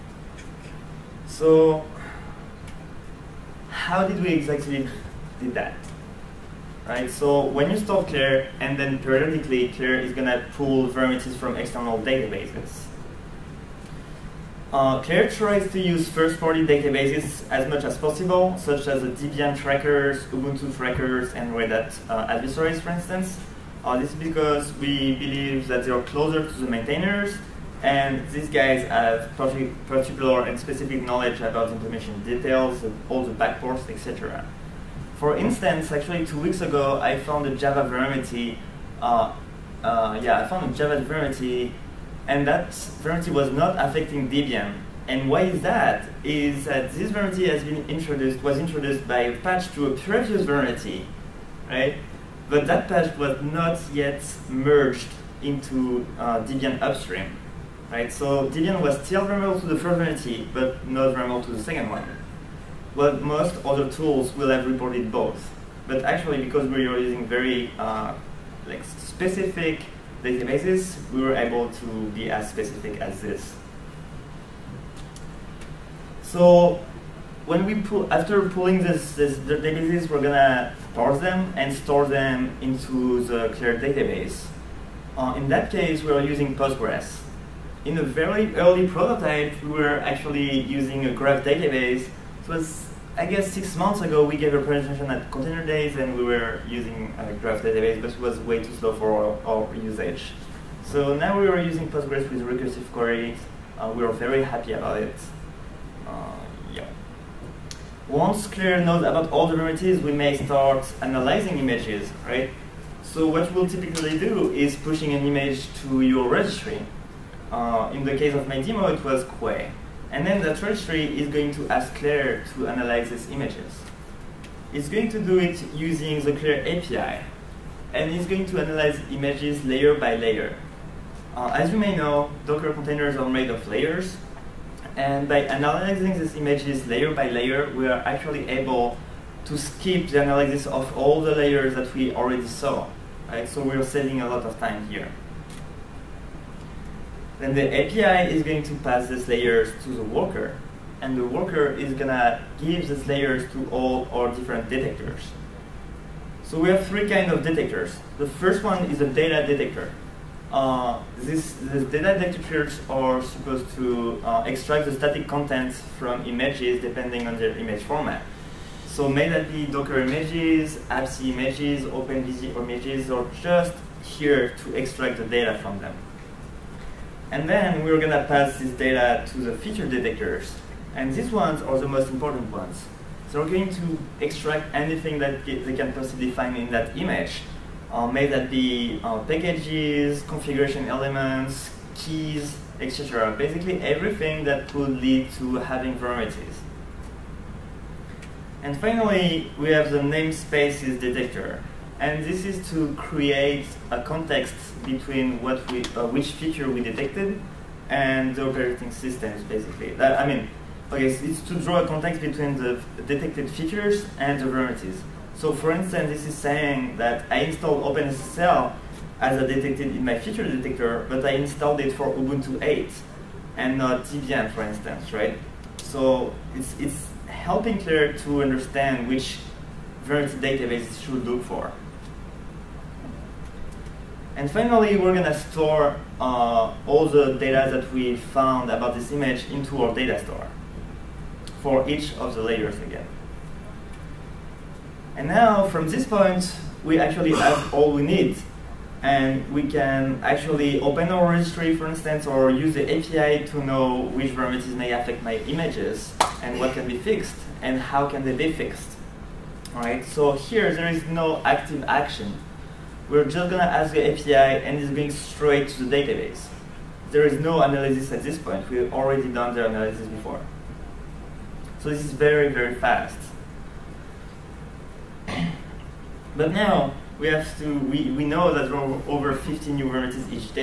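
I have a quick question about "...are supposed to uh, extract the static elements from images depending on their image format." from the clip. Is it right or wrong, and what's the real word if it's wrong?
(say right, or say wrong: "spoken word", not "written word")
wrong: "contents", not "elements".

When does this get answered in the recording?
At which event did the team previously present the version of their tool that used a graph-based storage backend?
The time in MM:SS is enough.
01:35.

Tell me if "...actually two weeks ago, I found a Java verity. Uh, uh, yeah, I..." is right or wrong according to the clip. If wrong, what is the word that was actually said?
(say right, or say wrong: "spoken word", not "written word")
right.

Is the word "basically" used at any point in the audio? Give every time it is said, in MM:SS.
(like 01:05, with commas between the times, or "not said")
03:13, 03:29.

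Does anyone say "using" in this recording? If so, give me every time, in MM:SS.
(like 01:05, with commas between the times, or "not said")
01:06, 01:26, 01:30, 01:36, 01:41, 02:05.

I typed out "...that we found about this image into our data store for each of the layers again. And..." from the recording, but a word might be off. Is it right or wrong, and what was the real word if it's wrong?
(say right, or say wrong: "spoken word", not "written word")
right.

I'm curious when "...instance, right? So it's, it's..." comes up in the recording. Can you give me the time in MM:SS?
03:44.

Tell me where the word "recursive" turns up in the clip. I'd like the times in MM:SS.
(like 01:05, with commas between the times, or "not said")
01:42.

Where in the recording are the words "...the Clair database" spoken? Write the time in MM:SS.
01:23.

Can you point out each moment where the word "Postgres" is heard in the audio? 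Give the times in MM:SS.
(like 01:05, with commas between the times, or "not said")
01:26, 01:41.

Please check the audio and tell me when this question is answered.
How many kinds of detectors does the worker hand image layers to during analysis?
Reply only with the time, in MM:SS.
02:36.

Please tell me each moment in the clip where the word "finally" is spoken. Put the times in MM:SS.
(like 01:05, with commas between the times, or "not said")
03:18, 03:54.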